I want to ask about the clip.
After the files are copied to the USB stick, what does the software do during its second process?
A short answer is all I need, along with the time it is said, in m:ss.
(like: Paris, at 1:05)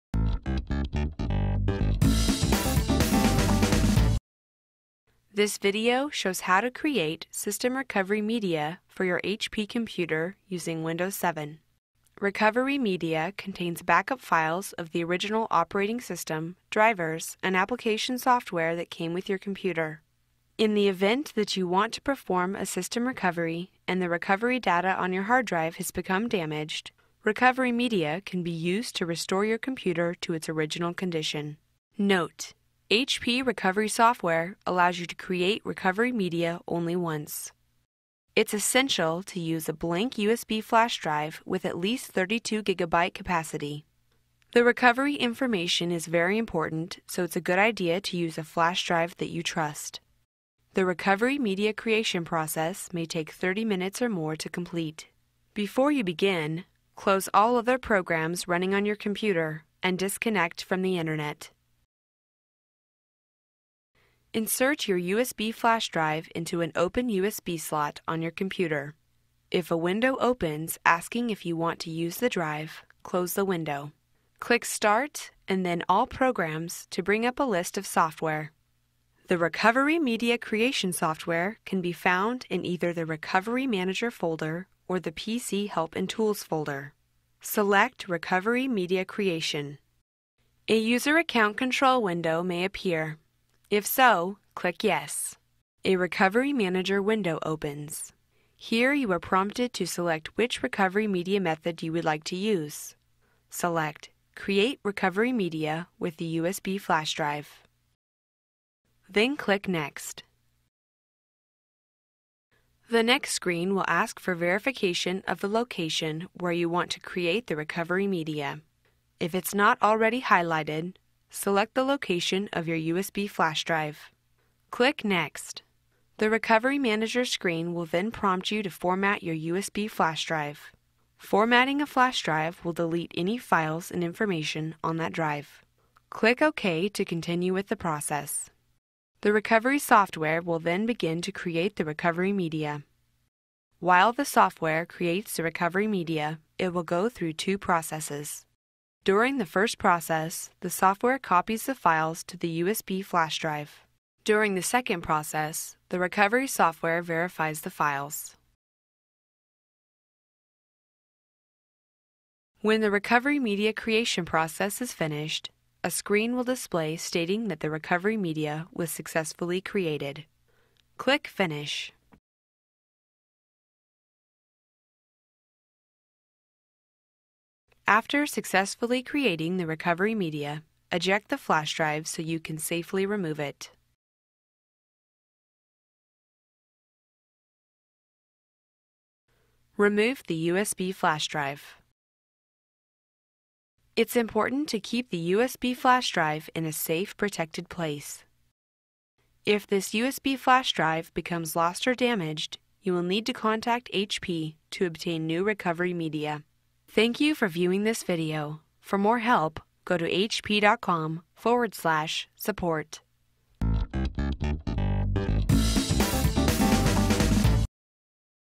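Verifies the files, at 2:37.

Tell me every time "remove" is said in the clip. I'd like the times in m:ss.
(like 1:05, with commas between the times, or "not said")
3:03, 3:09.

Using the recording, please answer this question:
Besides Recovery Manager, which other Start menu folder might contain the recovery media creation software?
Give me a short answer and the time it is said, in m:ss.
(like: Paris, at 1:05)
PC Help and Tools, at 1:25.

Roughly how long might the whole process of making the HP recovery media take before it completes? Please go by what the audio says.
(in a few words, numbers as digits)
30 minutes or more.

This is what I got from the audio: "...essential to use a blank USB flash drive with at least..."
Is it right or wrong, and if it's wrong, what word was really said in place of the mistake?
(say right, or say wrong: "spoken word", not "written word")
right.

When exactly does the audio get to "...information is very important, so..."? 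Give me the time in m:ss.
0:45.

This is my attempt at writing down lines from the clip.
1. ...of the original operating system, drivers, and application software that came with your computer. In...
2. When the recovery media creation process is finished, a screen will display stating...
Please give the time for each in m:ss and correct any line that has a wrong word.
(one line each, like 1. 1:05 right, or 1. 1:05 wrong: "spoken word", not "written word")
1. 0:14 right
2. 2:42 right.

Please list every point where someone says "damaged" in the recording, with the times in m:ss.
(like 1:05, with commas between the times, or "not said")
0:26, 3:21.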